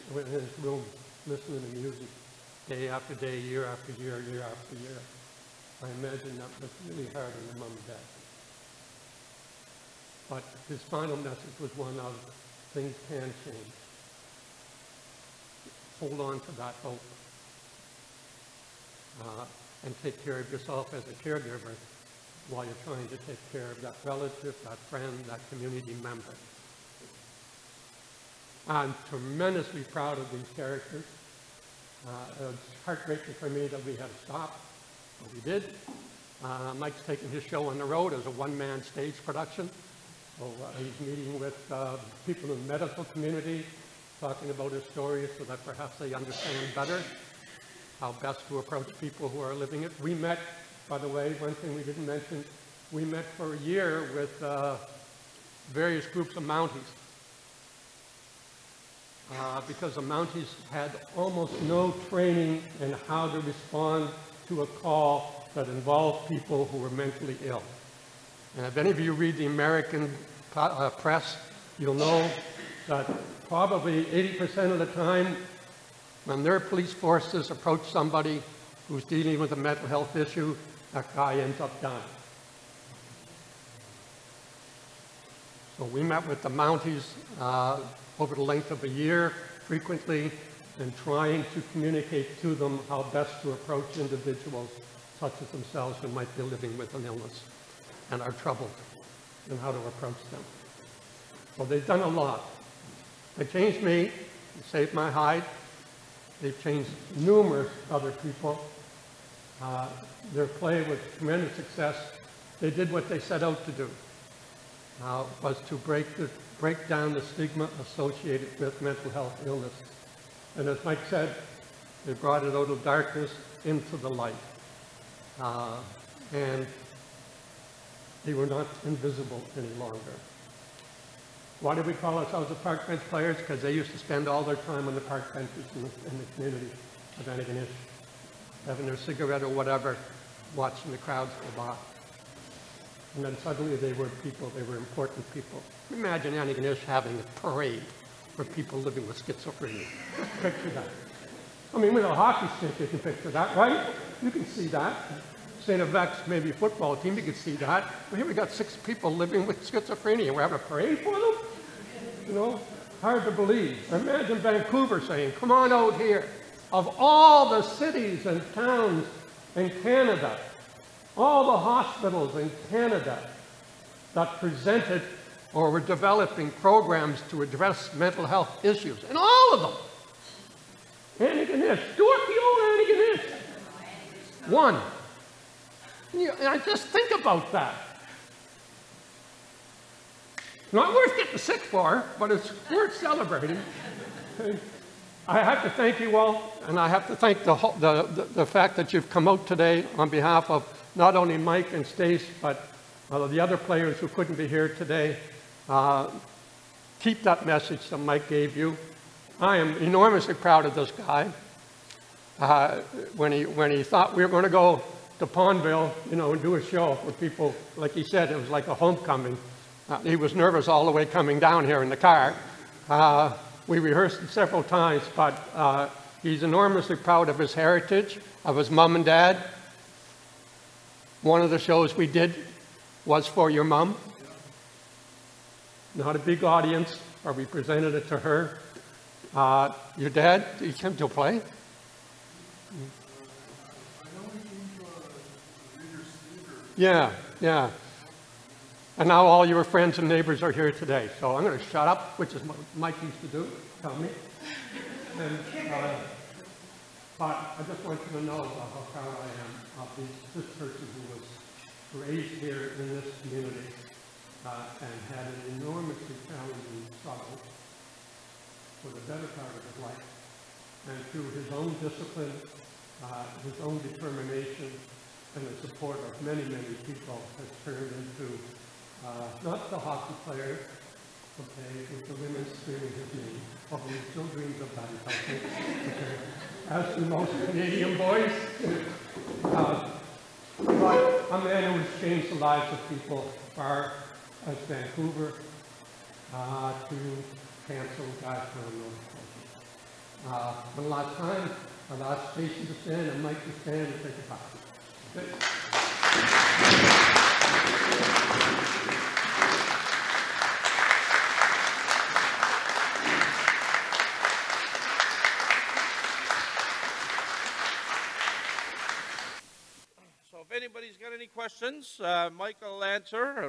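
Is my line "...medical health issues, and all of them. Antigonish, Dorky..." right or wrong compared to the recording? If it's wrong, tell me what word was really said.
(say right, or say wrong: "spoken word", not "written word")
wrong: "mental", not "medical".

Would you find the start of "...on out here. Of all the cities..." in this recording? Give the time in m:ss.
2:45.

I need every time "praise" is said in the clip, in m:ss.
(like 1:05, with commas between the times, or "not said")
not said.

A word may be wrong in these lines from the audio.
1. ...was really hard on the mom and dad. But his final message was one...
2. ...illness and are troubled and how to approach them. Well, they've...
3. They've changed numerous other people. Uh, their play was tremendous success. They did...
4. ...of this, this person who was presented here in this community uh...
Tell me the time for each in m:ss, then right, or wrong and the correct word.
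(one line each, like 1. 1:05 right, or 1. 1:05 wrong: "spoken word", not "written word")
1. 0:06 right
2. 1:37 right
3. 1:46 right
4. 4:19 wrong: "raised", not "presented".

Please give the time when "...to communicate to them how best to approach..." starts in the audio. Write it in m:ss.
1:31.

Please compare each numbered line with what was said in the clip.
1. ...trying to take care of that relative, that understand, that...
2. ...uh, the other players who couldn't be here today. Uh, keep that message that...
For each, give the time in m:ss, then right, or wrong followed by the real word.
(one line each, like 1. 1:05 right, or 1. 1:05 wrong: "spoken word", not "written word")
1. 0:22 wrong: "friend", not "understand"
2. 3:23 right.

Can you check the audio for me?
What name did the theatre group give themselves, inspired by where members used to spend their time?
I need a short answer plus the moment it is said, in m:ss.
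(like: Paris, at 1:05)
Park Bench Players, at 2:12.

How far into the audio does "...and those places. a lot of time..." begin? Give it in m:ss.
4:58.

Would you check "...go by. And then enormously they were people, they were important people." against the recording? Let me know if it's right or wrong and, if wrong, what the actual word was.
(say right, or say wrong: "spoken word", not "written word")
wrong: "suddenly", not "enormously".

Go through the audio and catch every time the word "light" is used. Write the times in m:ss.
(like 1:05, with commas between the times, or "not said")
2:04.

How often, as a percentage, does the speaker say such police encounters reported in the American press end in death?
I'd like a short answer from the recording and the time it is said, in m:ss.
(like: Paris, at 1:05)
80%, at 1:14.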